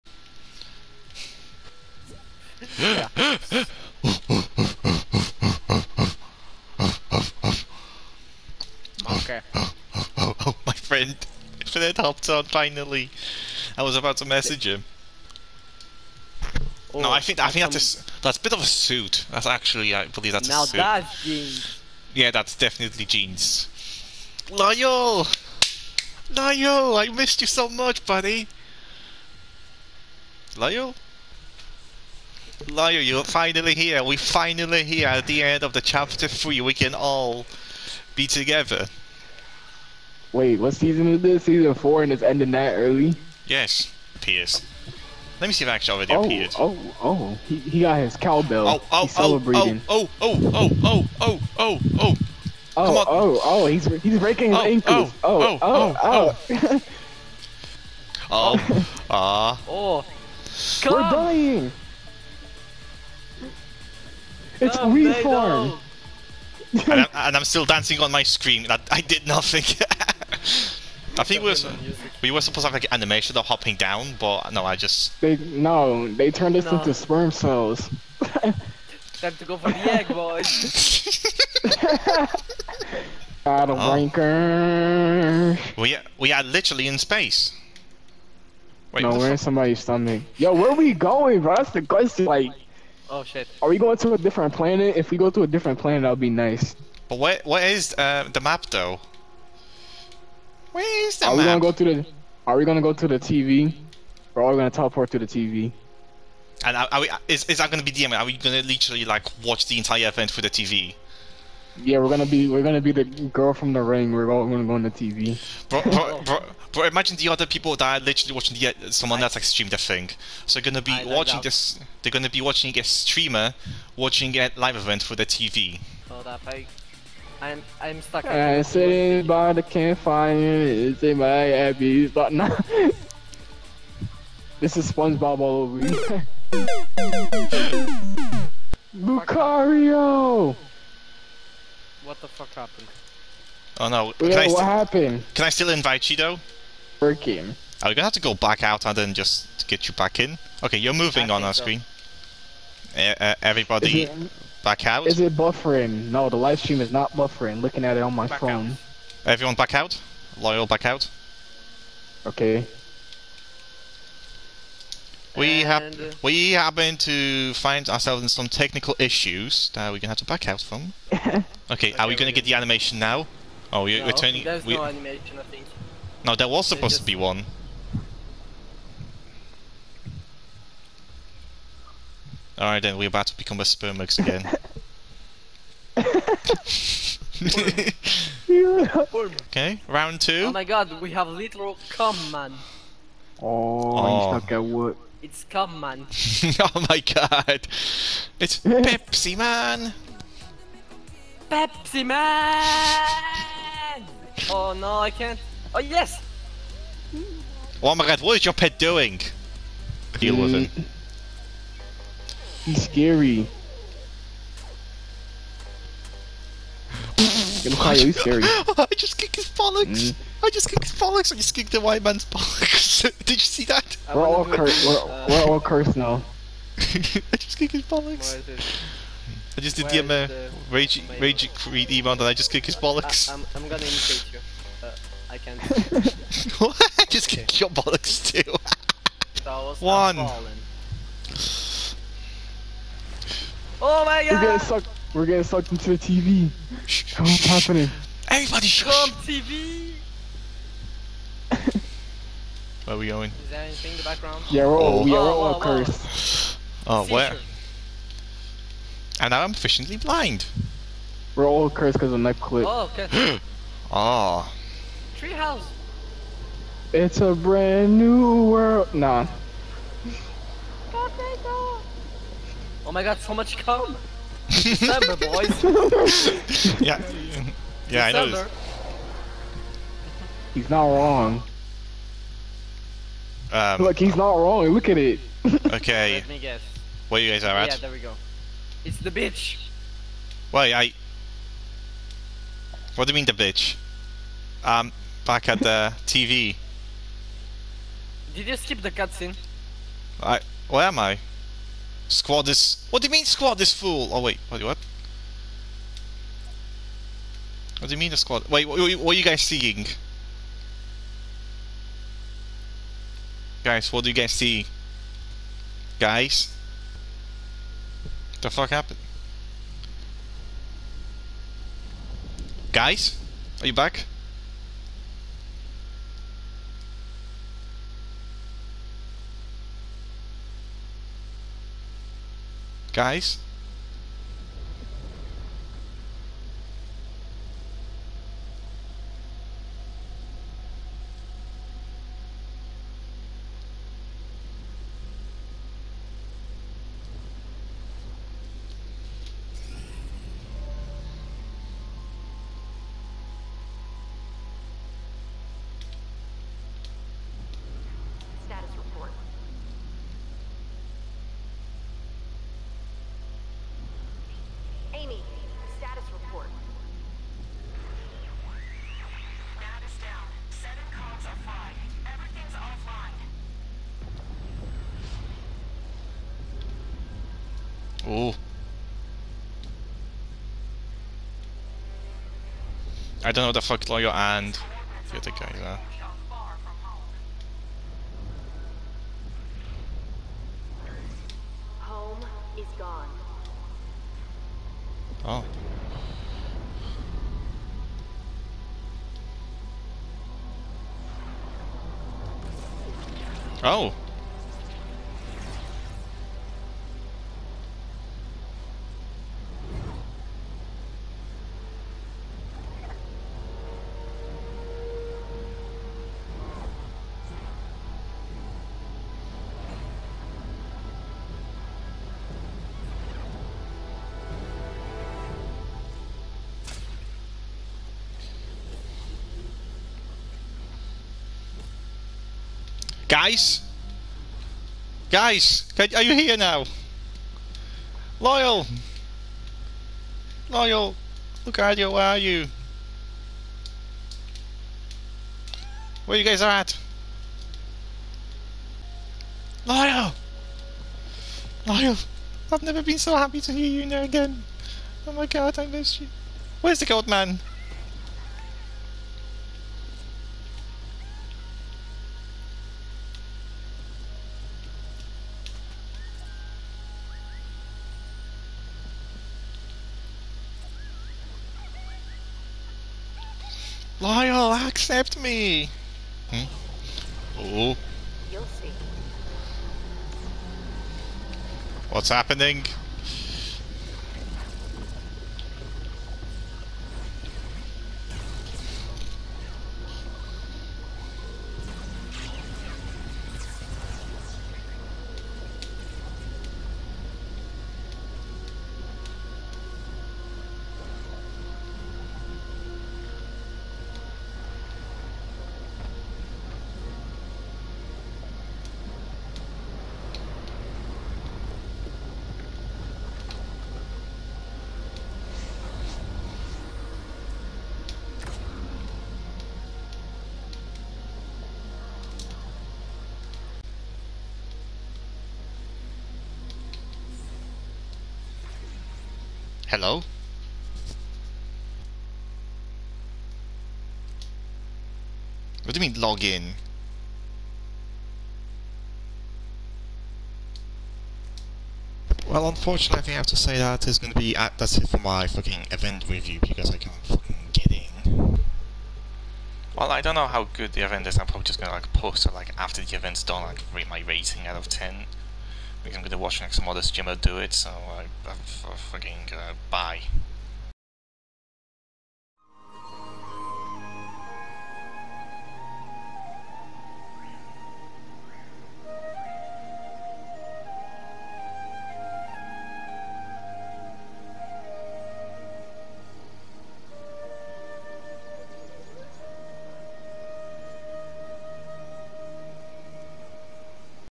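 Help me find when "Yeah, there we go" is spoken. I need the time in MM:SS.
04:47.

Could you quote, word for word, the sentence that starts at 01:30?
Yo, where are we going, bro?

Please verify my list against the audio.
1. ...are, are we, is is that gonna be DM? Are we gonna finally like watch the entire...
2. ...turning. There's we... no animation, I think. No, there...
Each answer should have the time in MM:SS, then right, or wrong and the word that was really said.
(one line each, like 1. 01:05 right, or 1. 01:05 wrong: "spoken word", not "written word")
1. 01:46 wrong: "literally", not "finally"
2. 02:54 right.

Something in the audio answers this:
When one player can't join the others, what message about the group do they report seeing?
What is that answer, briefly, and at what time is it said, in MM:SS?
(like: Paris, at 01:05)
squad is full, at 05:03.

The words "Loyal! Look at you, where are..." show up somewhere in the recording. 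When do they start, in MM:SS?
07:20.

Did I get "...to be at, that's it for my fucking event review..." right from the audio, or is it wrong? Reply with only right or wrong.
right.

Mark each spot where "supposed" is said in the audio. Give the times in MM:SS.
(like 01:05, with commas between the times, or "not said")
01:12, 02:56.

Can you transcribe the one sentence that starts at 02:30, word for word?
Okay, you're moving I on our so.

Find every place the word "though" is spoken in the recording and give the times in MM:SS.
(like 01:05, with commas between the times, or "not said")
01:38, 02:26.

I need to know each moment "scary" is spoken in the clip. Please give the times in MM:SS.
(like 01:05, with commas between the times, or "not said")
03:32, 03:38.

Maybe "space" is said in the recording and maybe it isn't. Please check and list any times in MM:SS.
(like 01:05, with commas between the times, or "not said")
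01:26.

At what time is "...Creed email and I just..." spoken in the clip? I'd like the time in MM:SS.
03:51.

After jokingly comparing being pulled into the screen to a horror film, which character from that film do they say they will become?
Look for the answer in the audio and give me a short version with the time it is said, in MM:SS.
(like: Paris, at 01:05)
the girl from the ring, at 01:52.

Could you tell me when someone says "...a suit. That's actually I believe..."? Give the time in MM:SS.
00:18.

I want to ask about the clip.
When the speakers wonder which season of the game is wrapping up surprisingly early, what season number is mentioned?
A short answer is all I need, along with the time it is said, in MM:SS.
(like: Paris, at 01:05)
Season 4, at 00:41.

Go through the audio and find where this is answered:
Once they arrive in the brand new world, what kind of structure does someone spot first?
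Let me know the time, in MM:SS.
04:25.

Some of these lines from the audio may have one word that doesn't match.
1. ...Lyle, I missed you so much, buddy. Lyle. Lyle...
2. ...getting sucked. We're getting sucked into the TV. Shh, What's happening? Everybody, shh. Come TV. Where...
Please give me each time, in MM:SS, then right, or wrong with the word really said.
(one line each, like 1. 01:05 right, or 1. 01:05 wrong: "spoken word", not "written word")
1. 00:26 right
2. 04:04 right.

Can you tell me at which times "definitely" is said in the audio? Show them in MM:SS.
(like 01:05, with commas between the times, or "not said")
00:22.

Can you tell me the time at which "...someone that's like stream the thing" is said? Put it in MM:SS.
01:58.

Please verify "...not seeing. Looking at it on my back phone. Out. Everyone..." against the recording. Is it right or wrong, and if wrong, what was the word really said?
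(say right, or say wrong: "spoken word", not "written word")
wrong: "buffering", not "seeing".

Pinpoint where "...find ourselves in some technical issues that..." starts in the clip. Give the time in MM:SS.
02:47.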